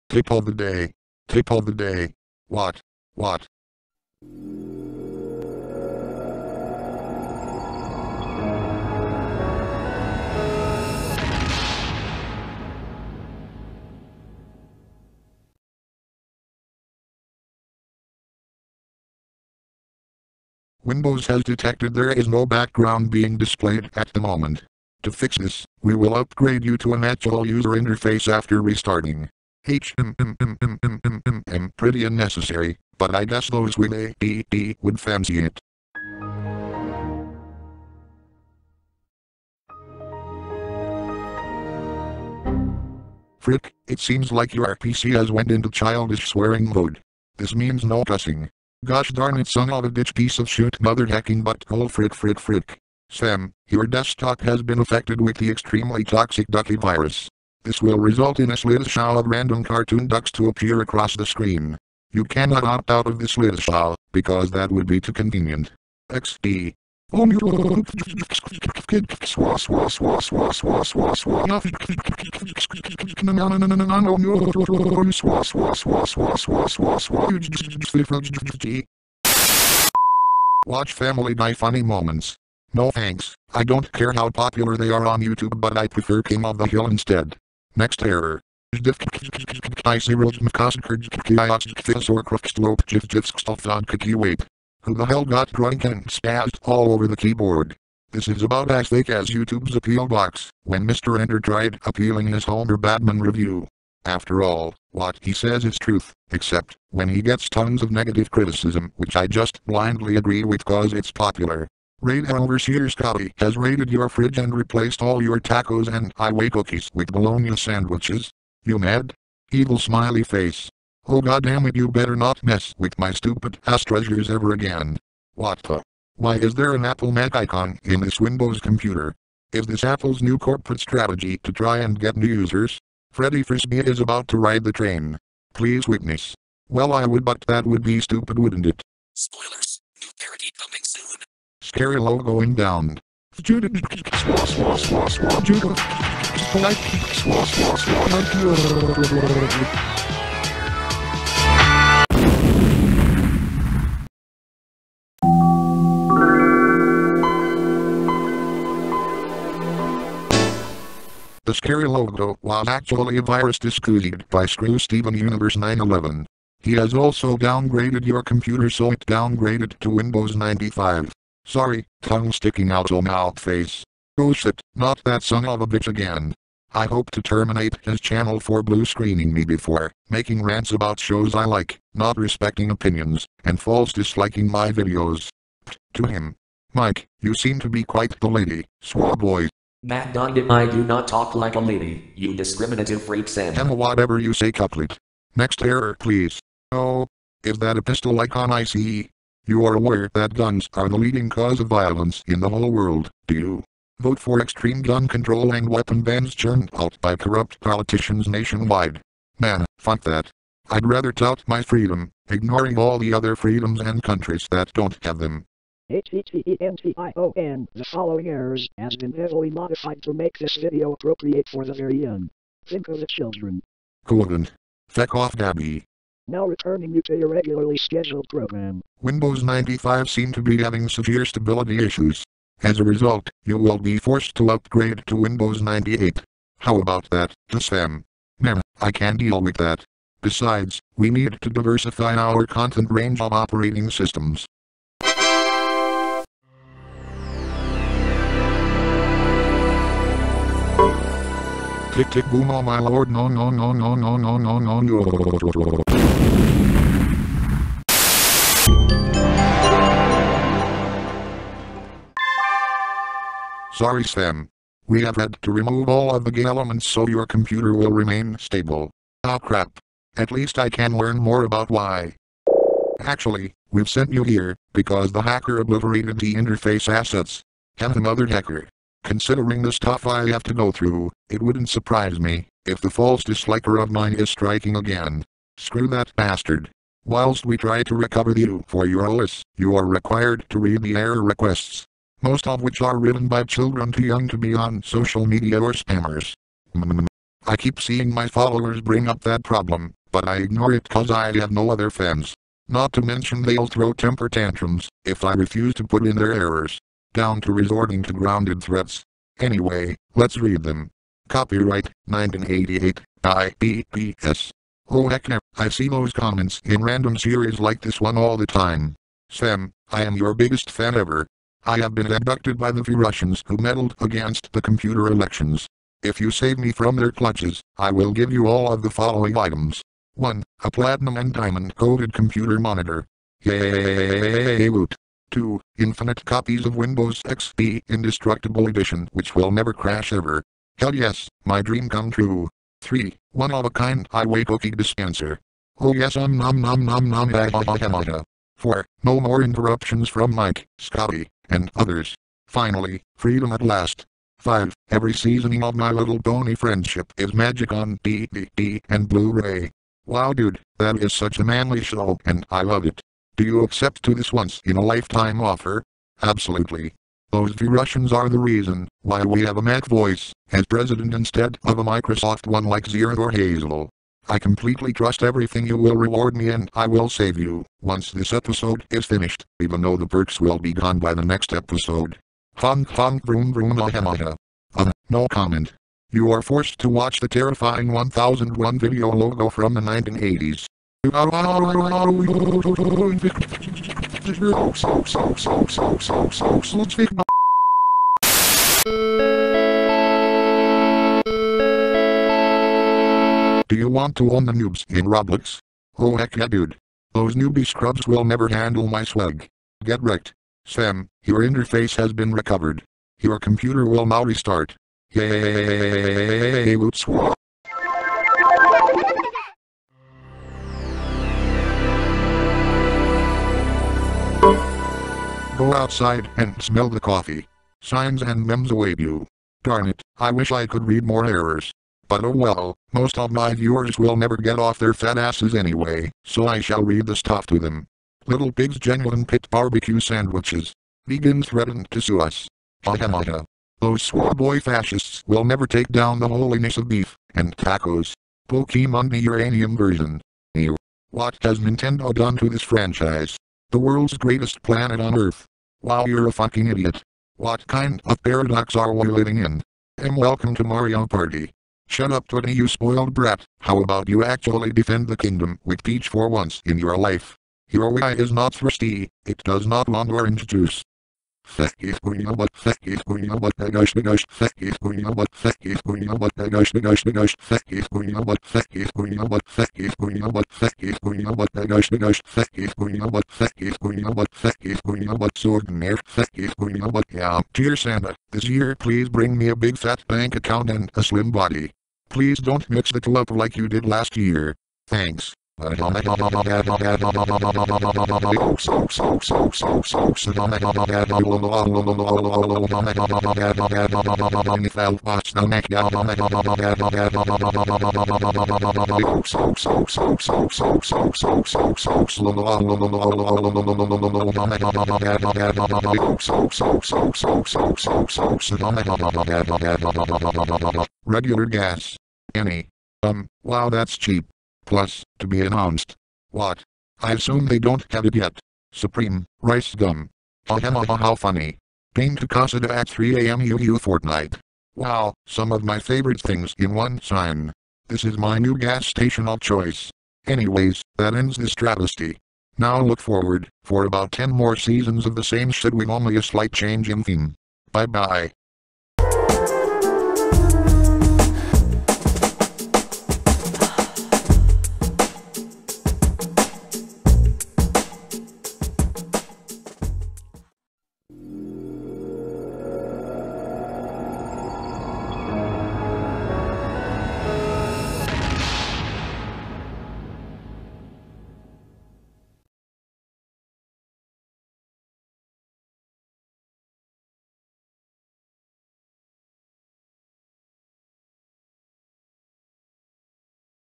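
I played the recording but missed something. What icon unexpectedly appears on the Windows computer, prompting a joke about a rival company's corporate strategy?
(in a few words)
Apple Mac.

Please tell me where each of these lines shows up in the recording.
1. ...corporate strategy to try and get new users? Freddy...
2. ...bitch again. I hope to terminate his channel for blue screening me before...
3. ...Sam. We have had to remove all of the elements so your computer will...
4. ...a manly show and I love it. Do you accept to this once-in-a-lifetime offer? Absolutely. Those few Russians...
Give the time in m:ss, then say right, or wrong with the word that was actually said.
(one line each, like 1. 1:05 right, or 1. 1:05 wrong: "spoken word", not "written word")
1. 2:10 right
2. 2:55 right
3. 4:24 right
4. 6:01 right.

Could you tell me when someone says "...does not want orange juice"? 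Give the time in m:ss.
7:49.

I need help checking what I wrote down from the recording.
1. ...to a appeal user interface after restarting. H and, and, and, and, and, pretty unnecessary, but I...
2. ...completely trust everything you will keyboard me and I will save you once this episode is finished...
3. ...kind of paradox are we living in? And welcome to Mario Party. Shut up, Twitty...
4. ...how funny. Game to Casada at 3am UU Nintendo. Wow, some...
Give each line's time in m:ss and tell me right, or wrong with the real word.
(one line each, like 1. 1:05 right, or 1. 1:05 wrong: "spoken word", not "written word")
1. 0:26 wrong: "natural", not "appeal"
2. 6:14 wrong: "reward", not "keyboard"
3. 7:37 right
4. 8:50 wrong: "Fortnite", not "Nintendo".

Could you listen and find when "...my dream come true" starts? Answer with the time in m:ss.
5:41.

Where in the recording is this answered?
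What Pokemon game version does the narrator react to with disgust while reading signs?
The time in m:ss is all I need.
7:29.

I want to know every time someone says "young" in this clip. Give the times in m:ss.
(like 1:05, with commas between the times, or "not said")
3:42, 4:54.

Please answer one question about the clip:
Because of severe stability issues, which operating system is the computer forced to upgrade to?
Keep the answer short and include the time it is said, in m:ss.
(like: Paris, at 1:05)
Windows 98, at 3:55.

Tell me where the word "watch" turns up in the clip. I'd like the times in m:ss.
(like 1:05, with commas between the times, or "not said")
1:20, 6:26.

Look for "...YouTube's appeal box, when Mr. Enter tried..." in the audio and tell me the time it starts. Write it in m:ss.
1:39.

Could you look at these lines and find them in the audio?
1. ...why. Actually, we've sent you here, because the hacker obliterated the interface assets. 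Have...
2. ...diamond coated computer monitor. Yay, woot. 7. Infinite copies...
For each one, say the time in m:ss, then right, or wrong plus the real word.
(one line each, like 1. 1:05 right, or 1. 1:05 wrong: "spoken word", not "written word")
1. 4:31 right
2. 5:31 wrong: "2", not "7".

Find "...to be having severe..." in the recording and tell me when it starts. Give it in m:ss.
3:50.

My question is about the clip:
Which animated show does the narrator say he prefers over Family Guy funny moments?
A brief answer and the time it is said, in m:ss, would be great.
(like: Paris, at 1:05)
King of the Hill, at 1:26.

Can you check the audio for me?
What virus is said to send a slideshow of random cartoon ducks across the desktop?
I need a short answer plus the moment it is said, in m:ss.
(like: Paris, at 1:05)
ducky virus, at 0:56.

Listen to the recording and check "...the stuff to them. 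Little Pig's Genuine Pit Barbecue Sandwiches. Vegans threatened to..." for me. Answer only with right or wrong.
right.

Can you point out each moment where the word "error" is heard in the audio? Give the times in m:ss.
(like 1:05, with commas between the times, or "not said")
1:28, 3:15, 3:38, 4:50, 5:06, 7:11.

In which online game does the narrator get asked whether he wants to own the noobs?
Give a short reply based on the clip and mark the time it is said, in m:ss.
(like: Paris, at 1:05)
Roblox, at 6:45.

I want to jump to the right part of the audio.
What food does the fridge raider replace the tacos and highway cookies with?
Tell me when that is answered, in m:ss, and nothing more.
1:57.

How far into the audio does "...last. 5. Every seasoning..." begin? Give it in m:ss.
5:53.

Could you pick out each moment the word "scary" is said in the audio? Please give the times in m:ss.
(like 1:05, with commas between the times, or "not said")
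2:21, 2:41.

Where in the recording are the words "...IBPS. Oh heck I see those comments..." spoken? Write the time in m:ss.
5:13.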